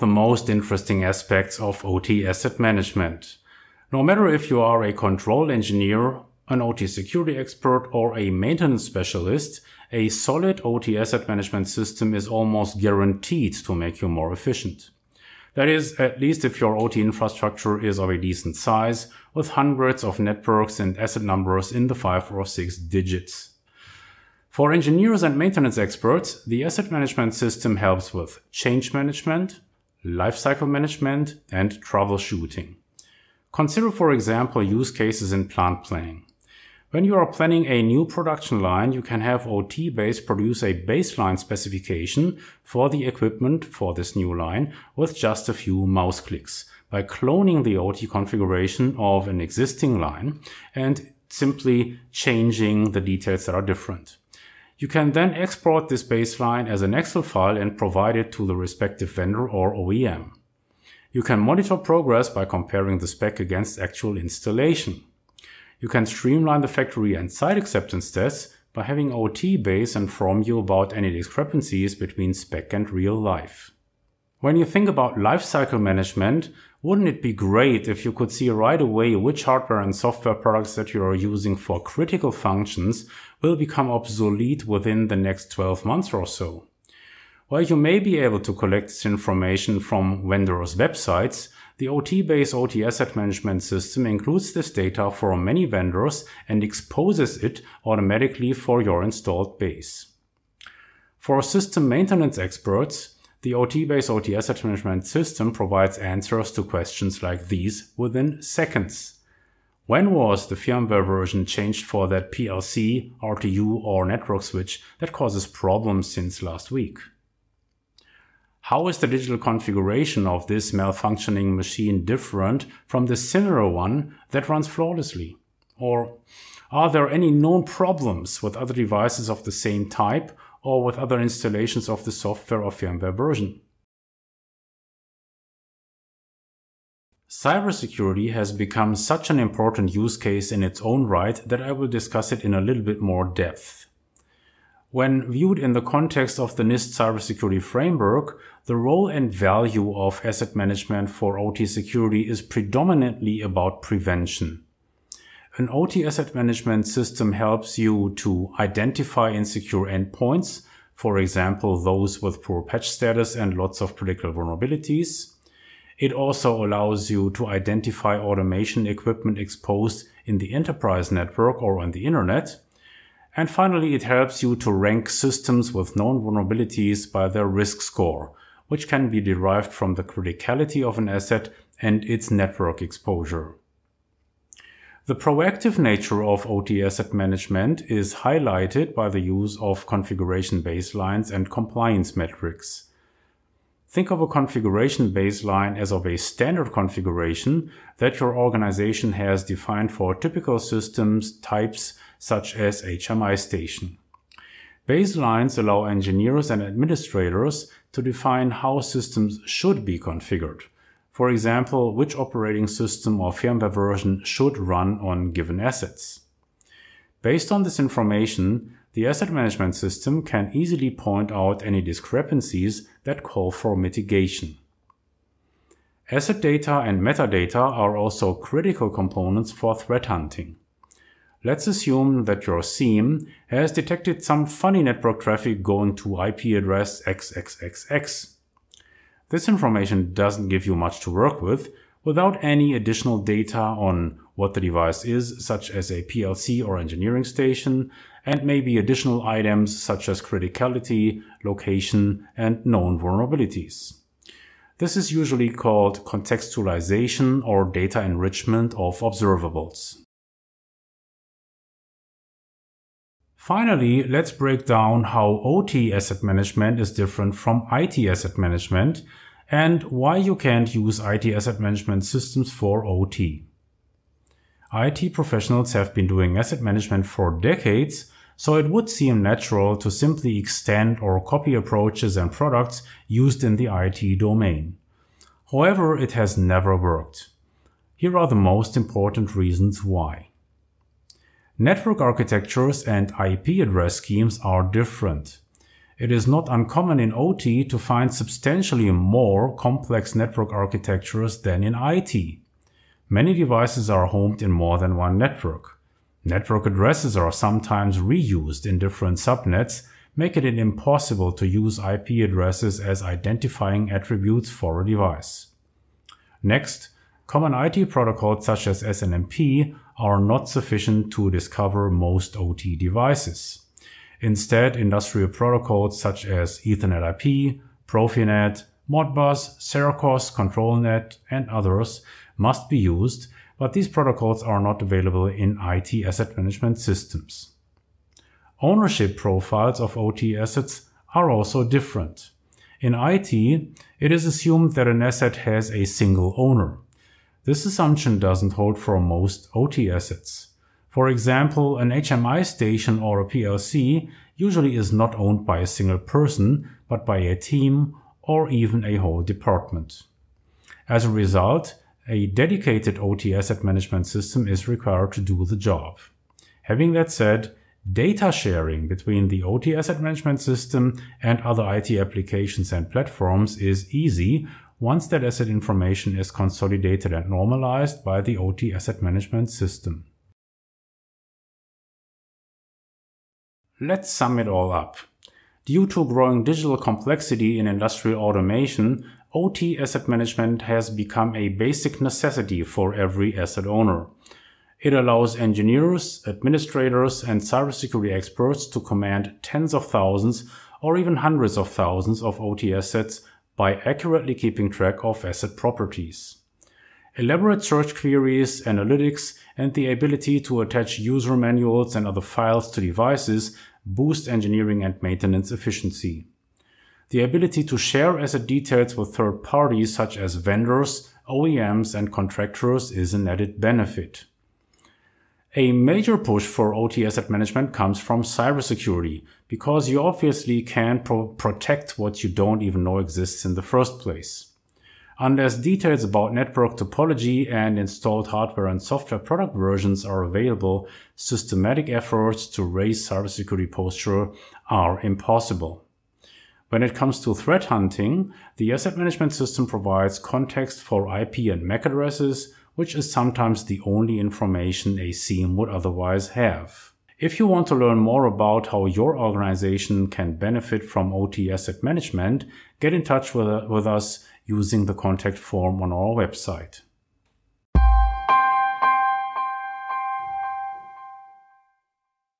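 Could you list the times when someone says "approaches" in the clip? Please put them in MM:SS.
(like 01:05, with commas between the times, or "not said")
04:41.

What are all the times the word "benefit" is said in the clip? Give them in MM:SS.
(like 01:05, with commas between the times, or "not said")
07:03, 07:40.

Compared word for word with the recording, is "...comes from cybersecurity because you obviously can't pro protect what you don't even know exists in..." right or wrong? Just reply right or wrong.
right.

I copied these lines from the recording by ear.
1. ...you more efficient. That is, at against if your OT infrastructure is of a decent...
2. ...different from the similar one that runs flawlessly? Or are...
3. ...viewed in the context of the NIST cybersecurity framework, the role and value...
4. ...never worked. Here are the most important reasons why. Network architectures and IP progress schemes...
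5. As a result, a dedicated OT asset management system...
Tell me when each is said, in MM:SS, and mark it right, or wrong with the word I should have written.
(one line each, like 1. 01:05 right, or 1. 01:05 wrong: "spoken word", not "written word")
1. 00:14 wrong: "least", not "against"
2. 02:02 right
3. 02:25 right
4. 04:46 wrong: "address", not "progress"
5. 06:00 right.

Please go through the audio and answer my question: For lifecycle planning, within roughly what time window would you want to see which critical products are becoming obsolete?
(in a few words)
12 months.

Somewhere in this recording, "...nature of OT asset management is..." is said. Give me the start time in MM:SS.
03:05.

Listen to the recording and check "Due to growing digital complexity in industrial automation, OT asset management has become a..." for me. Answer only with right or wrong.
right.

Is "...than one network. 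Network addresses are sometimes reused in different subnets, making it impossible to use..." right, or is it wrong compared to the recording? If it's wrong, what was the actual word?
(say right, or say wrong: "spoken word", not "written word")
right.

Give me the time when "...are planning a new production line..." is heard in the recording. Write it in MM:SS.
00:37.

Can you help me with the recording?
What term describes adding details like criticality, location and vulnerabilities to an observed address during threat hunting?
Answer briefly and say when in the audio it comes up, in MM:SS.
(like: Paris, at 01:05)
contextualization, at 04:16.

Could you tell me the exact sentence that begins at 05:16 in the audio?
Next, common IT protocols such as SNMP are not sufficient to discover most OT devices.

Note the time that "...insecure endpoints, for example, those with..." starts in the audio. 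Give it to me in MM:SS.
02:39.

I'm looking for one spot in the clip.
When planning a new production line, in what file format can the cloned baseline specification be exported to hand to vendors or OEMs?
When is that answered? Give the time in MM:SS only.
00:56.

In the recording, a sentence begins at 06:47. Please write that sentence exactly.
Elaborate search queries, analytics, and the ability to attach user manuals and other files to devices boost engineering and maintenance efficiency.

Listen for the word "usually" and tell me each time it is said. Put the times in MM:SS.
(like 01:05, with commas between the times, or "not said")
04:15, 05:54.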